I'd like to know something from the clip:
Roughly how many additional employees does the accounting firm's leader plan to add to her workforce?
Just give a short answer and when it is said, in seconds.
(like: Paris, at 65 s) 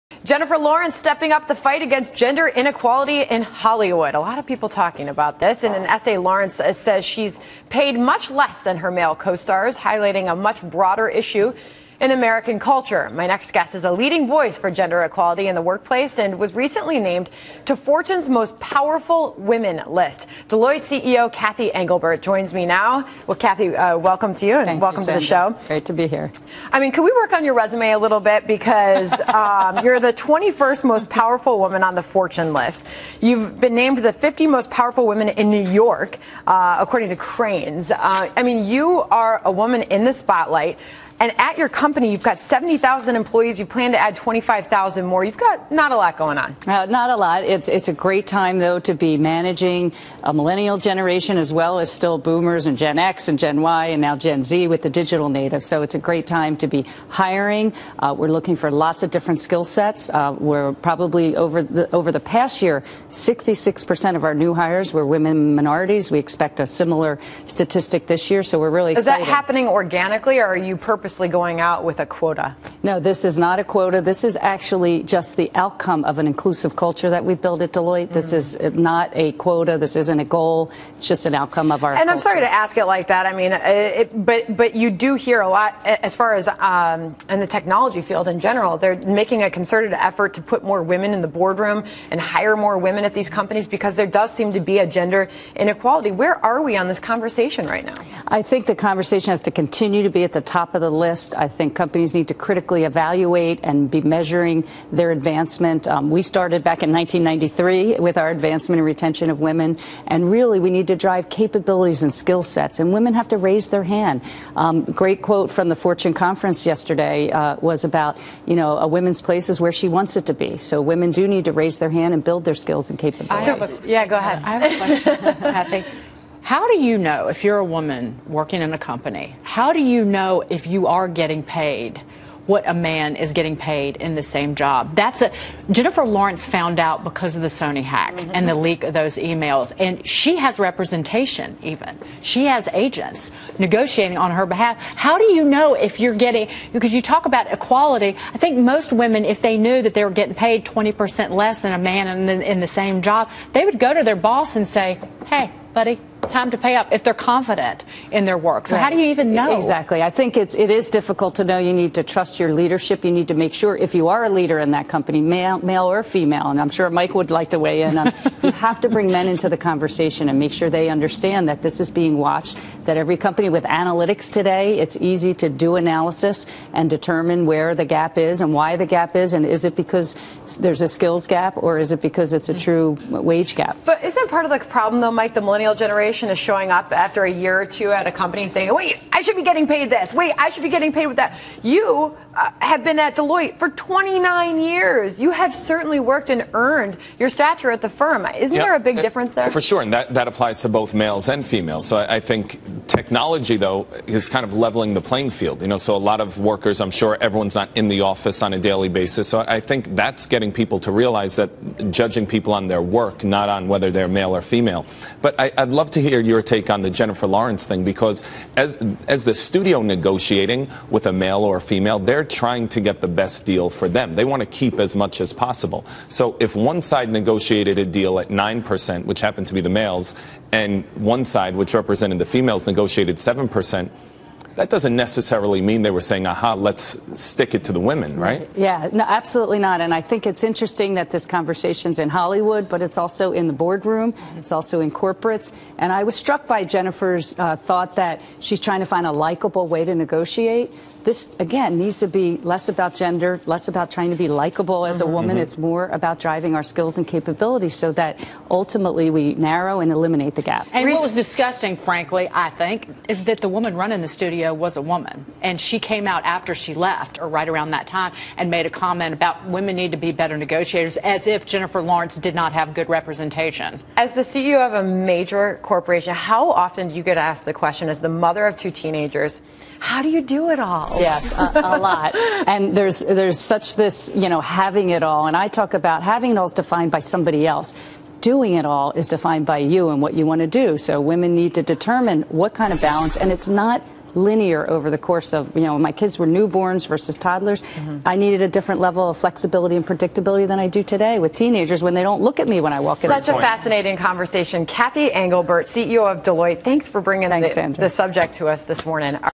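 25,000, at 44 s.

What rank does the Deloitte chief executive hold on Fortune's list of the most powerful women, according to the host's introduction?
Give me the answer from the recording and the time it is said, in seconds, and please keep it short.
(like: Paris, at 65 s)
21st, at 30 s.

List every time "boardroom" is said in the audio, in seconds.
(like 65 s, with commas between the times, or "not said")
91 s, 243 s.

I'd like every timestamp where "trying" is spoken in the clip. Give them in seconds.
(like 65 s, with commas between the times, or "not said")
222 s, 248 s, 253 s.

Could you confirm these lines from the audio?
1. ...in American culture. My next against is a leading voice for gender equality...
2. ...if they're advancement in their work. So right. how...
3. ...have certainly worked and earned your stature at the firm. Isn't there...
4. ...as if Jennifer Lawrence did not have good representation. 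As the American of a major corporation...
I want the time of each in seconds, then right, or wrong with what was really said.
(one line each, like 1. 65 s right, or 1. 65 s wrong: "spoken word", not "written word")
1. 12 s wrong: "guest", not "against"
2. 156 s wrong: "confident", not "advancement"
3. 195 s right
4. 270 s wrong: "CEO", not "American".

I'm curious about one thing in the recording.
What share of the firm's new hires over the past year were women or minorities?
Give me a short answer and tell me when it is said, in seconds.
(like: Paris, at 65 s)
66%, at 63 s.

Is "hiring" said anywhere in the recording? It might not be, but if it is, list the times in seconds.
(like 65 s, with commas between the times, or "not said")
57 s.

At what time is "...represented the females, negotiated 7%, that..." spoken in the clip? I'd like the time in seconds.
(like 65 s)
231 s.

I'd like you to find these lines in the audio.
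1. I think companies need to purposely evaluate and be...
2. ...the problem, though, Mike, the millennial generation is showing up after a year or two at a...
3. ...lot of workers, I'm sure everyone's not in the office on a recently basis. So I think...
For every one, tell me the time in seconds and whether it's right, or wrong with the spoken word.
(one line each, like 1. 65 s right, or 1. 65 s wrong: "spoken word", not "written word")
1. 101 s wrong: "critically", not "purposely"
2. 184 s right
3. 205 s wrong: "daily", not "recently".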